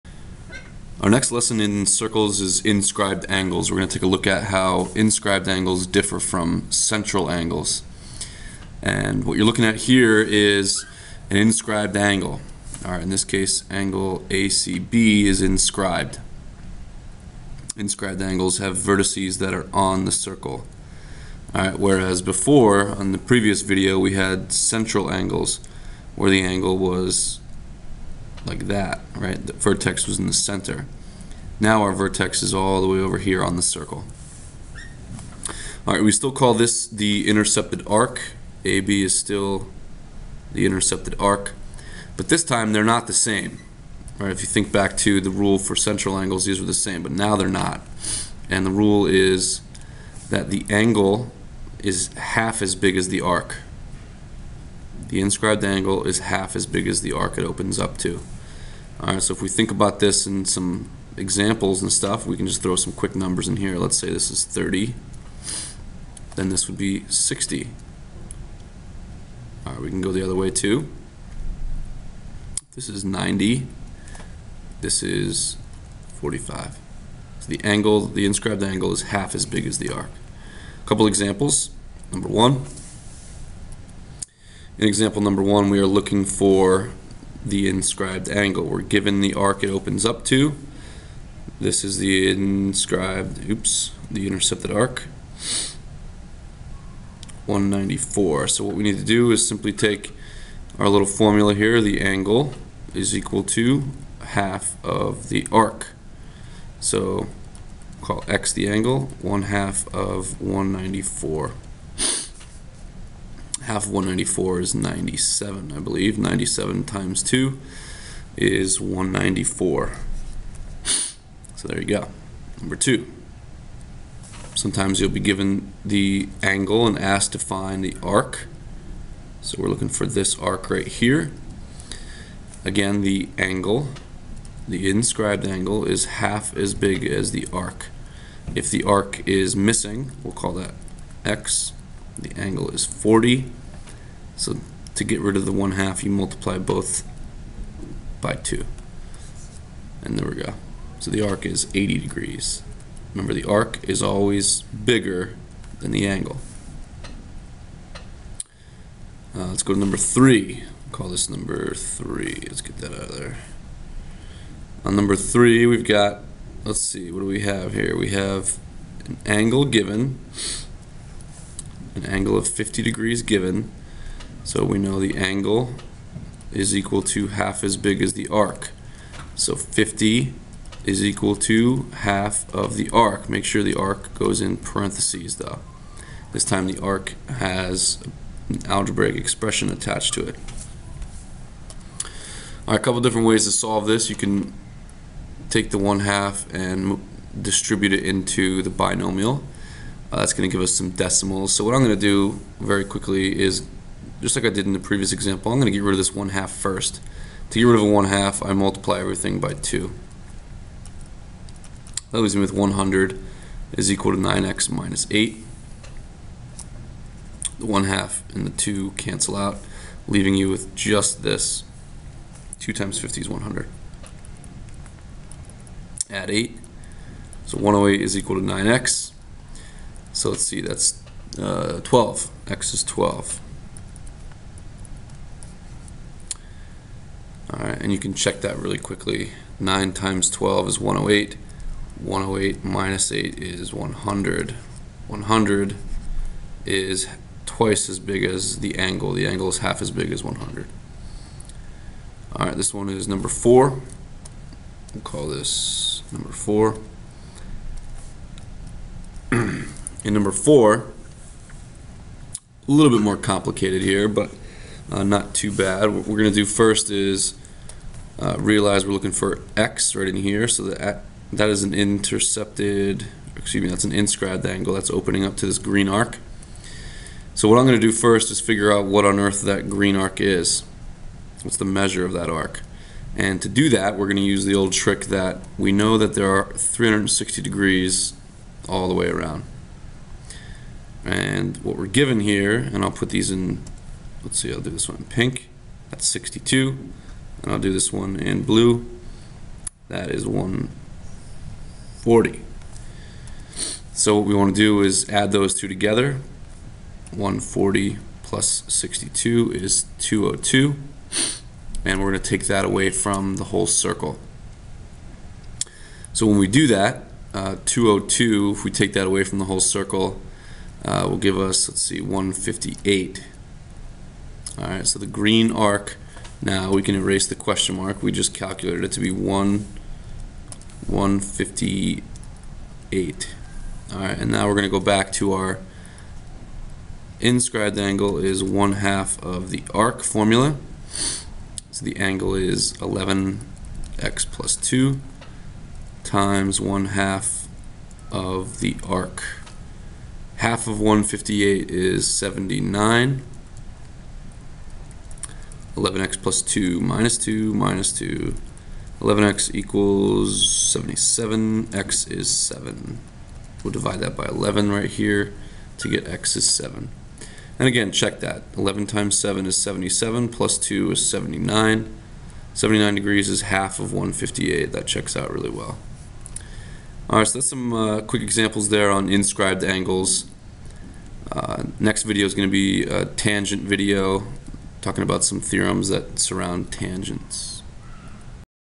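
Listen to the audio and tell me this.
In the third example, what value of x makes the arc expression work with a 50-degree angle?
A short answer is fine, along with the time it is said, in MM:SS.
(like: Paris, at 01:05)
12, at 03:52.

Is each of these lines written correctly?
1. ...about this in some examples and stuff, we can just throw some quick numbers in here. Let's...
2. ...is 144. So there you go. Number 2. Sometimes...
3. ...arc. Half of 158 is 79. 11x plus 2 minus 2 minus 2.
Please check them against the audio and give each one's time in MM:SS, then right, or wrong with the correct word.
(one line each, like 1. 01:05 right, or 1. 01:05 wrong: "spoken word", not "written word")
1. 00:59 right
2. 01:58 wrong: "194", not "144"
3. 05:48 right.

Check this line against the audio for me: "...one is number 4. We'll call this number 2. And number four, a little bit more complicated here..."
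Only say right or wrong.
wrong.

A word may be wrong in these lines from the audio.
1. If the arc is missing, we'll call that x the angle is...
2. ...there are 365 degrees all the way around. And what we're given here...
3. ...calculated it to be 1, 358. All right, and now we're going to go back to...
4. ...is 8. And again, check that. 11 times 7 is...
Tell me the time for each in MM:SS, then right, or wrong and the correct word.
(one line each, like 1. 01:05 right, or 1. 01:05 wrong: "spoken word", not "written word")
1. 02:18 right
2. 04:46 wrong: "360", not "365"
3. 05:28 wrong: "158", not "358"
4. 06:06 wrong: "7", not "8".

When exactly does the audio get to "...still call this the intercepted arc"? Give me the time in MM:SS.
00:36.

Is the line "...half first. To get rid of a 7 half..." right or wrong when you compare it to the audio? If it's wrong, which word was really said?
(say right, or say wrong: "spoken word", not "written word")
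wrong: "1", not "7".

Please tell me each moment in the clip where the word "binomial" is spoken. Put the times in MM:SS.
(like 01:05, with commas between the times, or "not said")
03:18.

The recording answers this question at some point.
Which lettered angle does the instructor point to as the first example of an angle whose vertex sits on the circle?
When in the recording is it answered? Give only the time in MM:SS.
00:14.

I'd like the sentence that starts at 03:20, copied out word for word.
Uh, that's going to give us some decimals.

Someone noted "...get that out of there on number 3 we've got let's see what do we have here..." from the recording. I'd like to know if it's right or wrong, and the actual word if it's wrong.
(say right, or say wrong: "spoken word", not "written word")
right.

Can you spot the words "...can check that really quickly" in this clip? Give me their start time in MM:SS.
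03:57.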